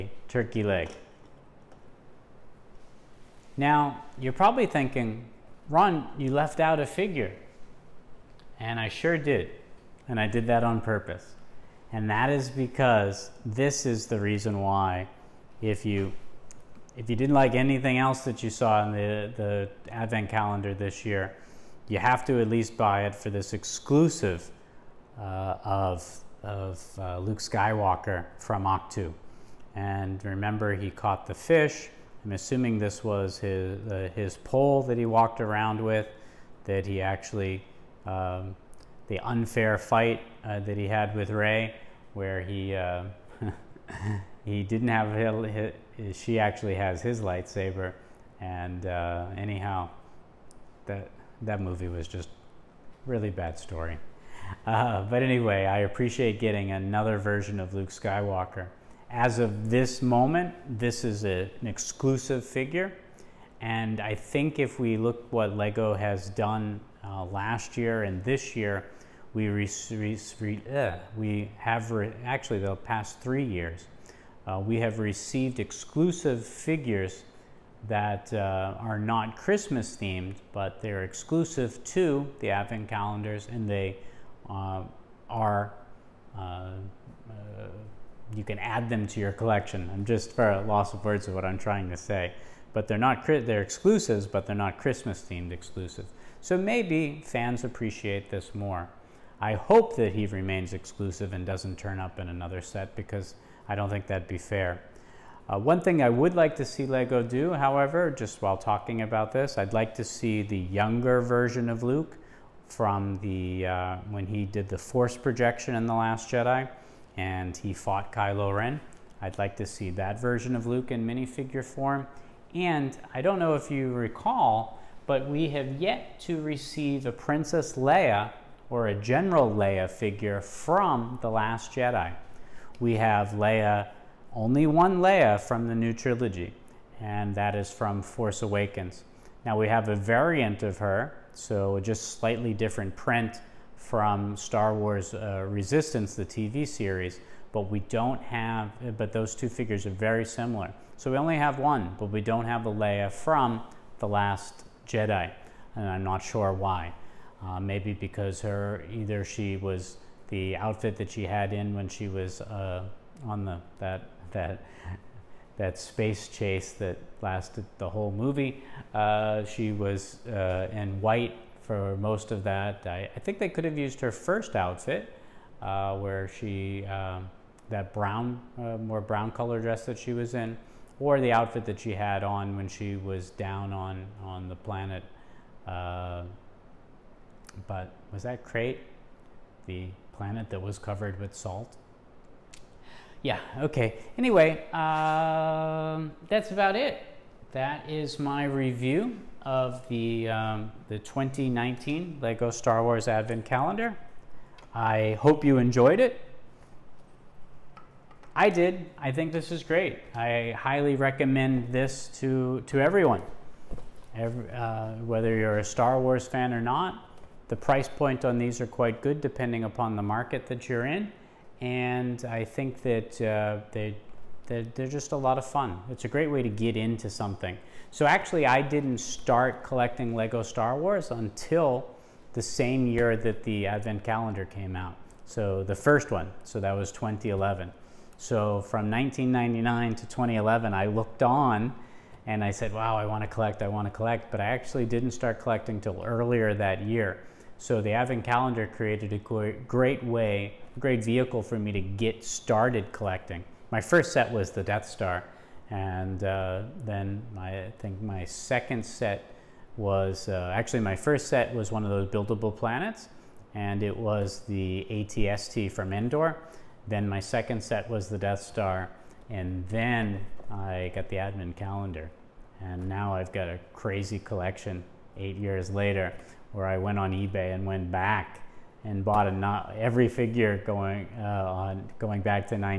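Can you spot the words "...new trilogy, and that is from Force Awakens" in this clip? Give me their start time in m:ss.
2:15.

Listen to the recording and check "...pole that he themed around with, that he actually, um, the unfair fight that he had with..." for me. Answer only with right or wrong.
wrong.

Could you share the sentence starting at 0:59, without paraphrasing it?
As of this moment, this is a, an exclusive figure.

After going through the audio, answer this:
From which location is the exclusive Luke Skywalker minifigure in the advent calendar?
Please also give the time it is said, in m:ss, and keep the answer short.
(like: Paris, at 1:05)
Ahch-To, at 0:28.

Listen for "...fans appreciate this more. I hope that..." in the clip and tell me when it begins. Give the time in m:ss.
1:37.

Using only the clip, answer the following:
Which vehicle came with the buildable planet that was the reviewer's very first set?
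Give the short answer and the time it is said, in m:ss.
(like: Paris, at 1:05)
AT-ST from Endor, at 4:24.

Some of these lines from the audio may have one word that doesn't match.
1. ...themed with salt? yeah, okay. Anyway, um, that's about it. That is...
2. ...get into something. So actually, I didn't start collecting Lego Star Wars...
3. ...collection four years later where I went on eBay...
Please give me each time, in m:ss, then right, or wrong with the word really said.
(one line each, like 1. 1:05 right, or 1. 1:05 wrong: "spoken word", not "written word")
1. 3:10 wrong: "covered", not "themed"
2. 3:46 right
3. 4:34 wrong: "eight", not "four".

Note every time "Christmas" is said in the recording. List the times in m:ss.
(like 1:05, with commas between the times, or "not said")
1:19, 1:34.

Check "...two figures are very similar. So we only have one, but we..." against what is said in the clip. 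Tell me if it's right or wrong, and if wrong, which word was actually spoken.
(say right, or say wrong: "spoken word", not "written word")
right.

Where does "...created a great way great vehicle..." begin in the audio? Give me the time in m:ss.
4:08.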